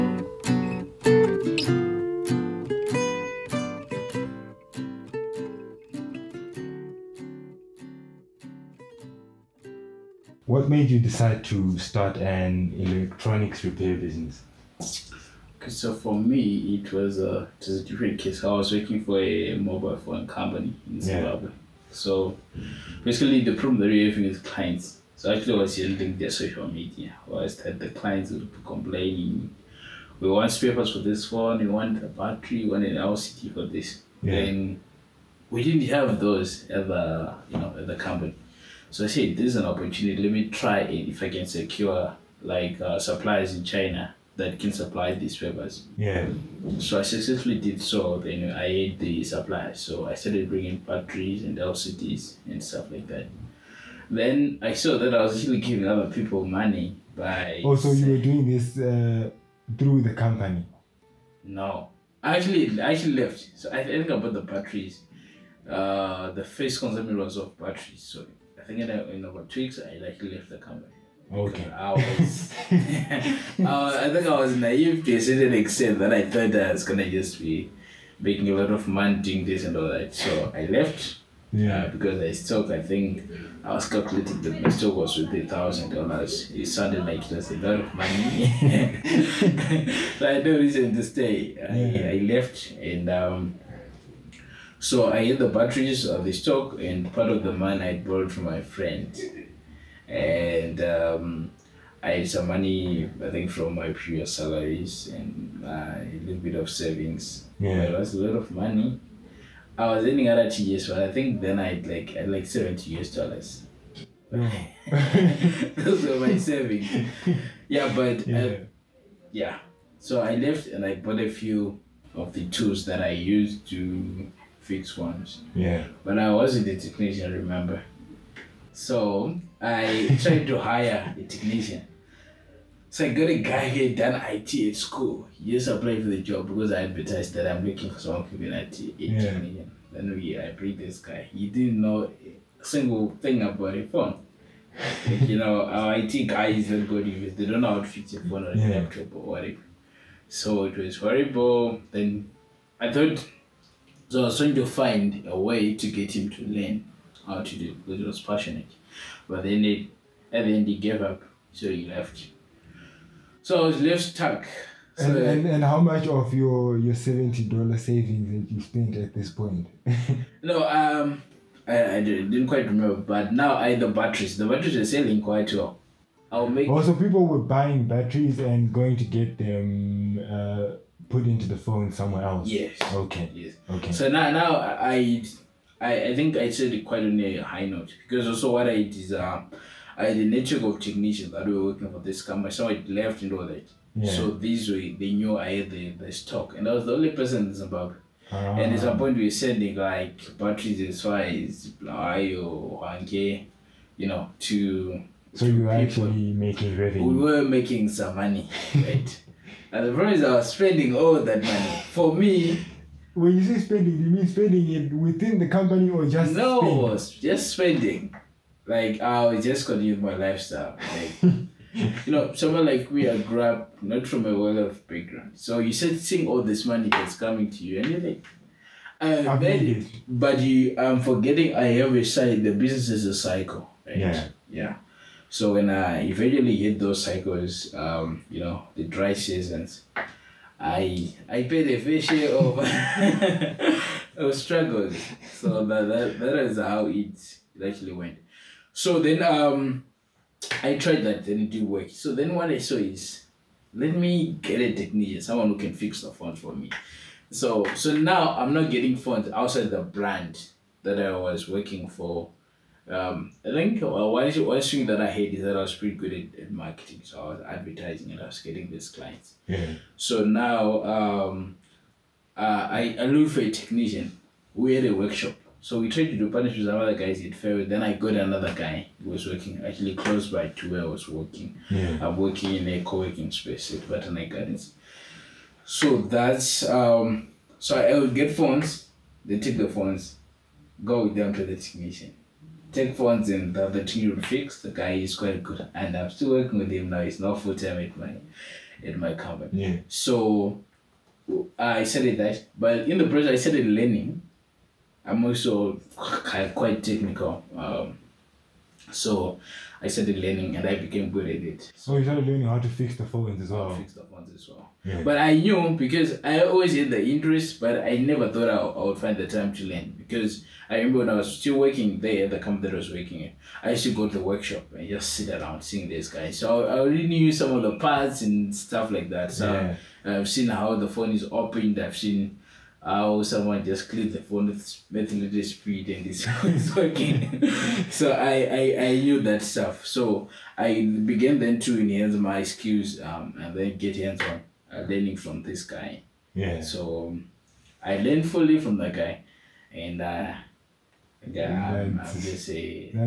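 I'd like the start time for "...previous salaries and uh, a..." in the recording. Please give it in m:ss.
1:43.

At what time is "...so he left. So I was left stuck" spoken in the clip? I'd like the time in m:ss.
2:41.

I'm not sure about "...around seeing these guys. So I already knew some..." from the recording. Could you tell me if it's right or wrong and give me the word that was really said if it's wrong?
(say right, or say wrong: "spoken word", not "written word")
right.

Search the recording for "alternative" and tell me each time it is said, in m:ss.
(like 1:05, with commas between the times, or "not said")
not said.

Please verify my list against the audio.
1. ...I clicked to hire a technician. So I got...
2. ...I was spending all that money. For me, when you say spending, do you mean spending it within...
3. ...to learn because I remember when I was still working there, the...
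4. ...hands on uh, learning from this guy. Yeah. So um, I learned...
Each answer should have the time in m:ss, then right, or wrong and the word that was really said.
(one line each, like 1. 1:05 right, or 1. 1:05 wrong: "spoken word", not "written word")
1. 2:09 wrong: "tried", not "clicked"
2. 3:30 right
3. 5:19 right
4. 5:43 right.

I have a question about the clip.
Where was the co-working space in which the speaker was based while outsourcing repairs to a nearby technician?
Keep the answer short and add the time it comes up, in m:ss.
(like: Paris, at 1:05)
Botanic Gardens, at 4:43.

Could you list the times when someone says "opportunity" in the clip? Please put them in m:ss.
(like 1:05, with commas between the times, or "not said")
0:39.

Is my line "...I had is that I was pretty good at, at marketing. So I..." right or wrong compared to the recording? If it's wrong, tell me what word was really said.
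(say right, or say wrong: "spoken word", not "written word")
right.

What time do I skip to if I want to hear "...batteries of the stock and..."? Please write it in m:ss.
1:35.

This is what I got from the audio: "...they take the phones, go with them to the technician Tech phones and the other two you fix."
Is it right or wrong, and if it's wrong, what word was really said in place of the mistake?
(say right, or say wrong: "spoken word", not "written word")
right.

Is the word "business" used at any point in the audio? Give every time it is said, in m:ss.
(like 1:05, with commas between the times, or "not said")
0:13, 3:52.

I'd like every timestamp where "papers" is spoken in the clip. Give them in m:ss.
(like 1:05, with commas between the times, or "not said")
0:30, 0:45.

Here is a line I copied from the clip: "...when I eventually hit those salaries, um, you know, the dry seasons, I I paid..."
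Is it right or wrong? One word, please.
wrong.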